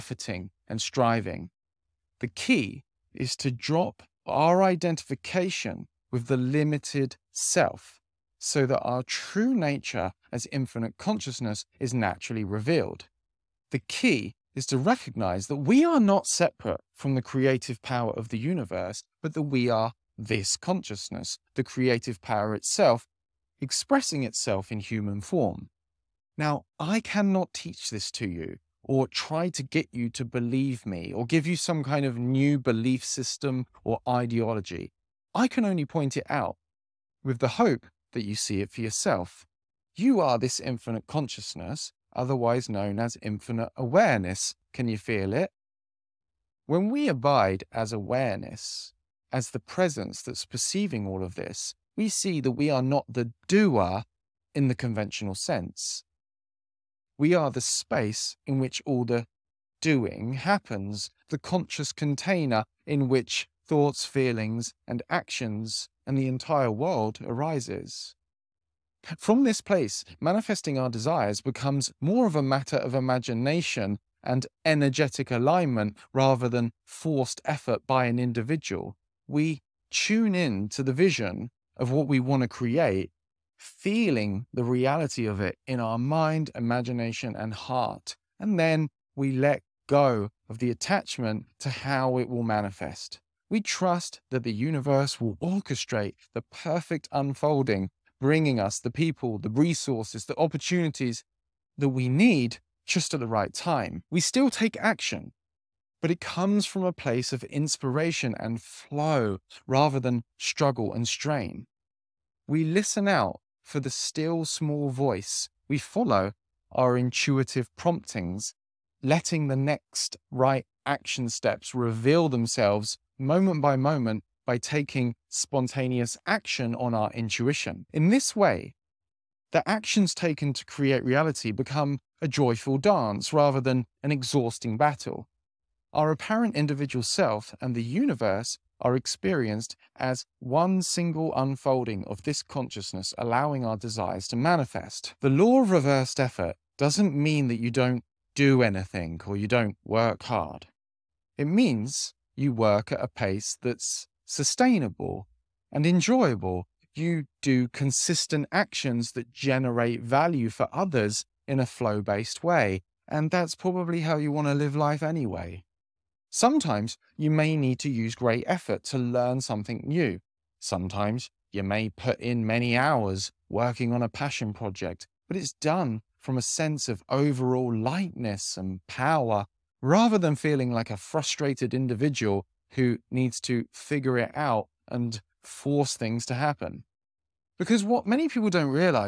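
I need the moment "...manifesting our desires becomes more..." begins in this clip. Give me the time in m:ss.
1:10.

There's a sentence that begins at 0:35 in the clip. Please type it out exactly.
I can only point it out with the hope that you see it for yourself.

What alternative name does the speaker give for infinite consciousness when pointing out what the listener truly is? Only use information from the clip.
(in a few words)
infinite awareness.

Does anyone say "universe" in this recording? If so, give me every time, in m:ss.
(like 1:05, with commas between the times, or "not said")
0:18, 1:34, 2:17.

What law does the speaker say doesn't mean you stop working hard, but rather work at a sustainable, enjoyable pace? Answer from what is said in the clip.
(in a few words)
the law of reversed effort.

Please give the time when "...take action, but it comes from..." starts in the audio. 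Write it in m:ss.
1:44.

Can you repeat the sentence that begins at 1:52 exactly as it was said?
We listen out for the still small voice.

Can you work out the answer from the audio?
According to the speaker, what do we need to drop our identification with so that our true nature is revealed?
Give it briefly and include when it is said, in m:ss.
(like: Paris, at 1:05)
the limited self, at 0:06.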